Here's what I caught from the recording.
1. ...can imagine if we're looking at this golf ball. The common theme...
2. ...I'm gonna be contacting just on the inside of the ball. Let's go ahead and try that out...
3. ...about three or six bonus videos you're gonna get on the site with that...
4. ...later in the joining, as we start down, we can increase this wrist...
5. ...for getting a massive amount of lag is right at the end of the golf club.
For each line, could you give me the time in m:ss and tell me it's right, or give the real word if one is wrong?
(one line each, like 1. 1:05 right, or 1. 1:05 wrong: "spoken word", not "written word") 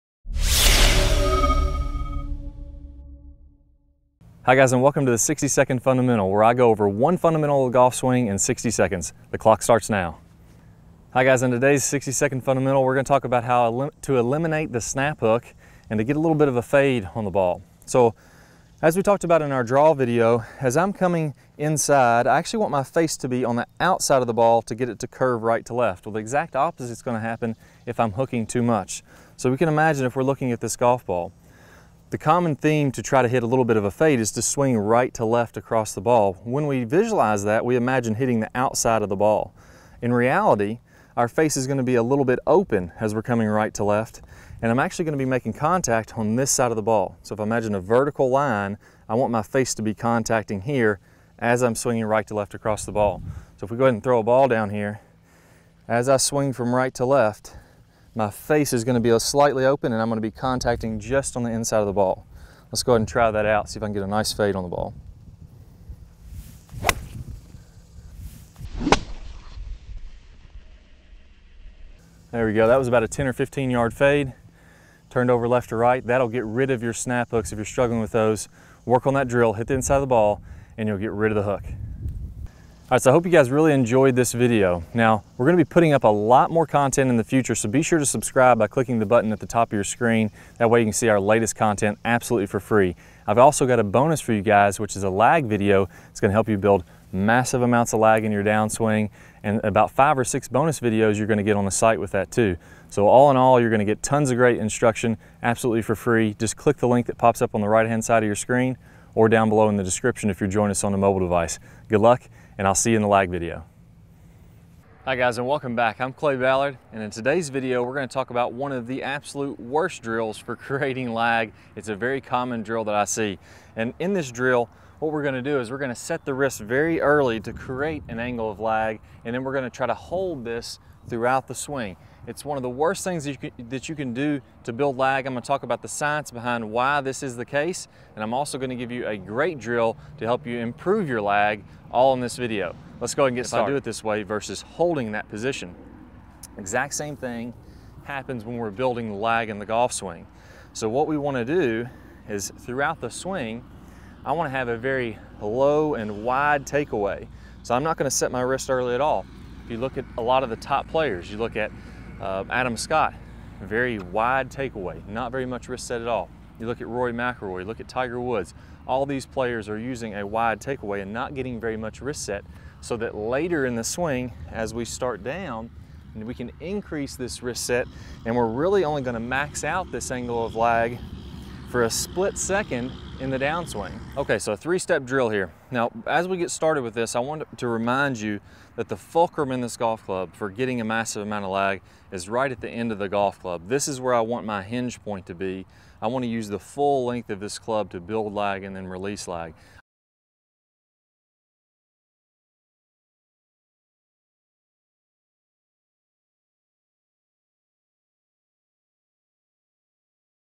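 1. 0:29 right
2. 1:00 right
3. 1:39 wrong: "five", not "three"
4. 2:53 wrong: "swing", not "joining"
5. 3:10 right.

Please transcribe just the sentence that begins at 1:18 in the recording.
Work on that drill, hit the inside of the ball, and you'll get rid of the hook.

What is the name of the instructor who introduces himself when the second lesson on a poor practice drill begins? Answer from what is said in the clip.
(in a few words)
Clay Ballard.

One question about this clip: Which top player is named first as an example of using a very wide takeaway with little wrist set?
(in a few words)
Adam Scott.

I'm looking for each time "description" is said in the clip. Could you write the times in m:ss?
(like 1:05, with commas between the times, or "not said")
1:49.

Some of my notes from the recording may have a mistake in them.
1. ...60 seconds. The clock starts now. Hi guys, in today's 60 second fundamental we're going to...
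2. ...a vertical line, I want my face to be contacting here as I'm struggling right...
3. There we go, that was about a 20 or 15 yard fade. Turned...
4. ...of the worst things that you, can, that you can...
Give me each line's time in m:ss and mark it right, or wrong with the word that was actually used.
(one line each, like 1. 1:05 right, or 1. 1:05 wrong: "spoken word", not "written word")
1. 0:08 right
2. 0:47 wrong: "swinging", not "struggling"
3. 1:12 wrong: "10", not "20"
4. 2:12 right.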